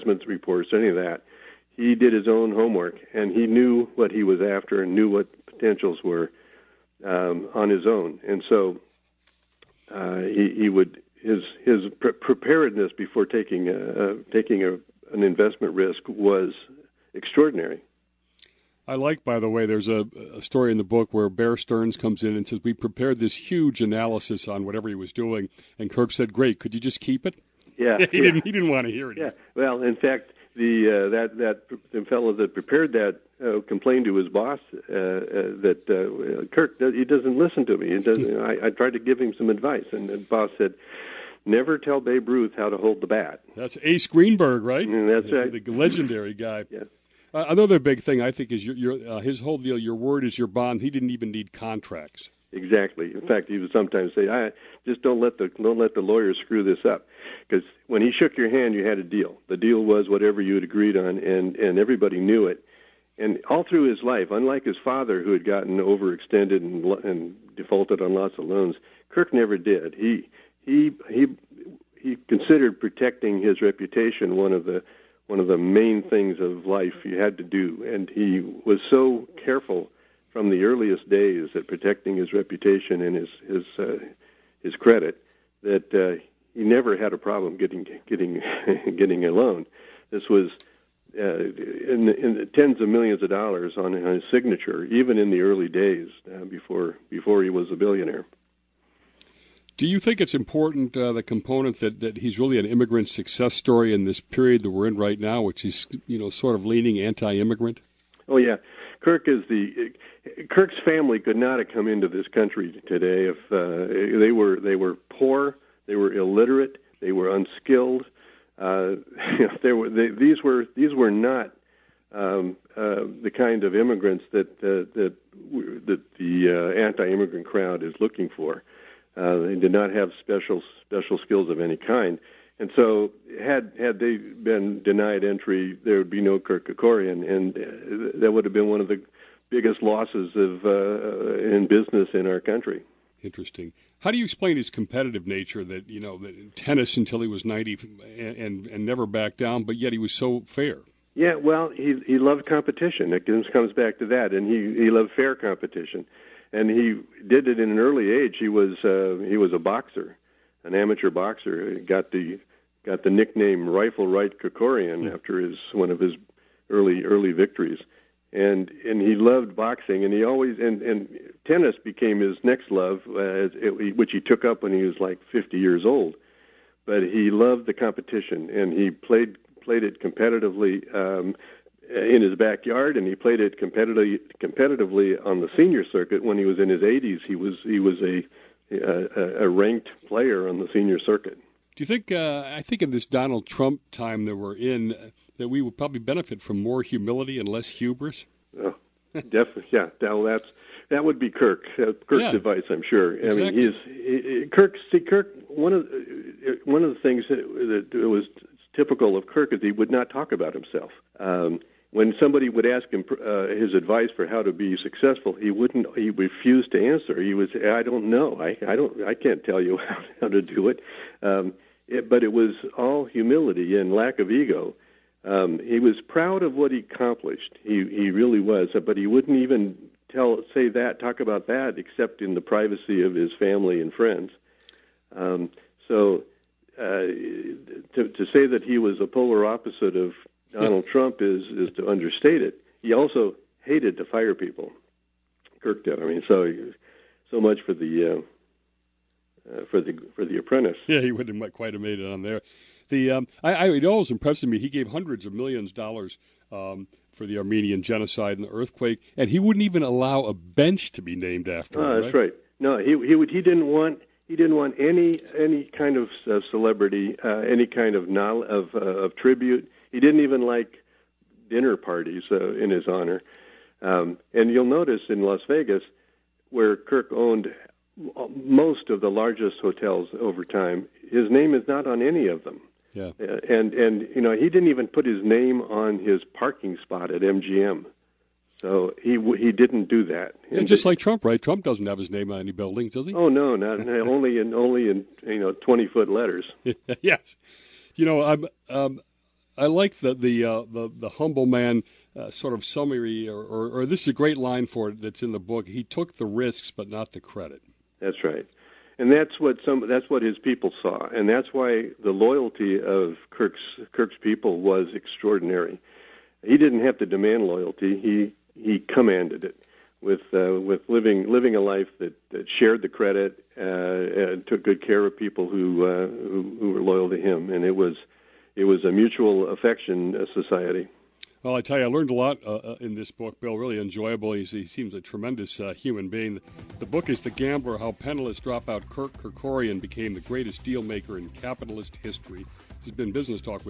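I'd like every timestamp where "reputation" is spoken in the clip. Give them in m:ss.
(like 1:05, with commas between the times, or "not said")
1:13, 1:22.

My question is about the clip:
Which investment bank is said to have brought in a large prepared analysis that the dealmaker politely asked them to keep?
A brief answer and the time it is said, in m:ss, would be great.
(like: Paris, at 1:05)
Bear Stearns, at 0:21.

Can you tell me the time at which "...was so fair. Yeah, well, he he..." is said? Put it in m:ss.
2:29.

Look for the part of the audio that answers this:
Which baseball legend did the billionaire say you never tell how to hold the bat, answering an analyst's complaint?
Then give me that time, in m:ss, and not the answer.
0:41.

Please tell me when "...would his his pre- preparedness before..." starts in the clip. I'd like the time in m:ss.
0:10.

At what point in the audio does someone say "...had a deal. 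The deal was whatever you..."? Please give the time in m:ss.
0:58.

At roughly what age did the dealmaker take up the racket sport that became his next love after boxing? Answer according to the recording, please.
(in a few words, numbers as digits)
50.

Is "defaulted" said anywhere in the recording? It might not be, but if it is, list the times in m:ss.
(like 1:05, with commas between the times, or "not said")
1:07.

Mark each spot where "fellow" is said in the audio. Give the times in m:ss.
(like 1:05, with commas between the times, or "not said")
0:32.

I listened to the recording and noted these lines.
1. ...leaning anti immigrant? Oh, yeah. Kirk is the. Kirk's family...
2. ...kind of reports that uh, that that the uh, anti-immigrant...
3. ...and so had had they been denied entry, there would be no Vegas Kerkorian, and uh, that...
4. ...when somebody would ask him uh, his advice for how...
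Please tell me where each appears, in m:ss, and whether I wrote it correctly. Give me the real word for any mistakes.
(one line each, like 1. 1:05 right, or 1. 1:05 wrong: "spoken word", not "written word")
1. 1:46 right
2. 2:03 wrong: "immigrants", not "reports"
3. 2:12 wrong: "Kirk", not "Vegas"
4. 3:31 right.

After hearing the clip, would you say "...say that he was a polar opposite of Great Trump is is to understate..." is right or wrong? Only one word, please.
wrong.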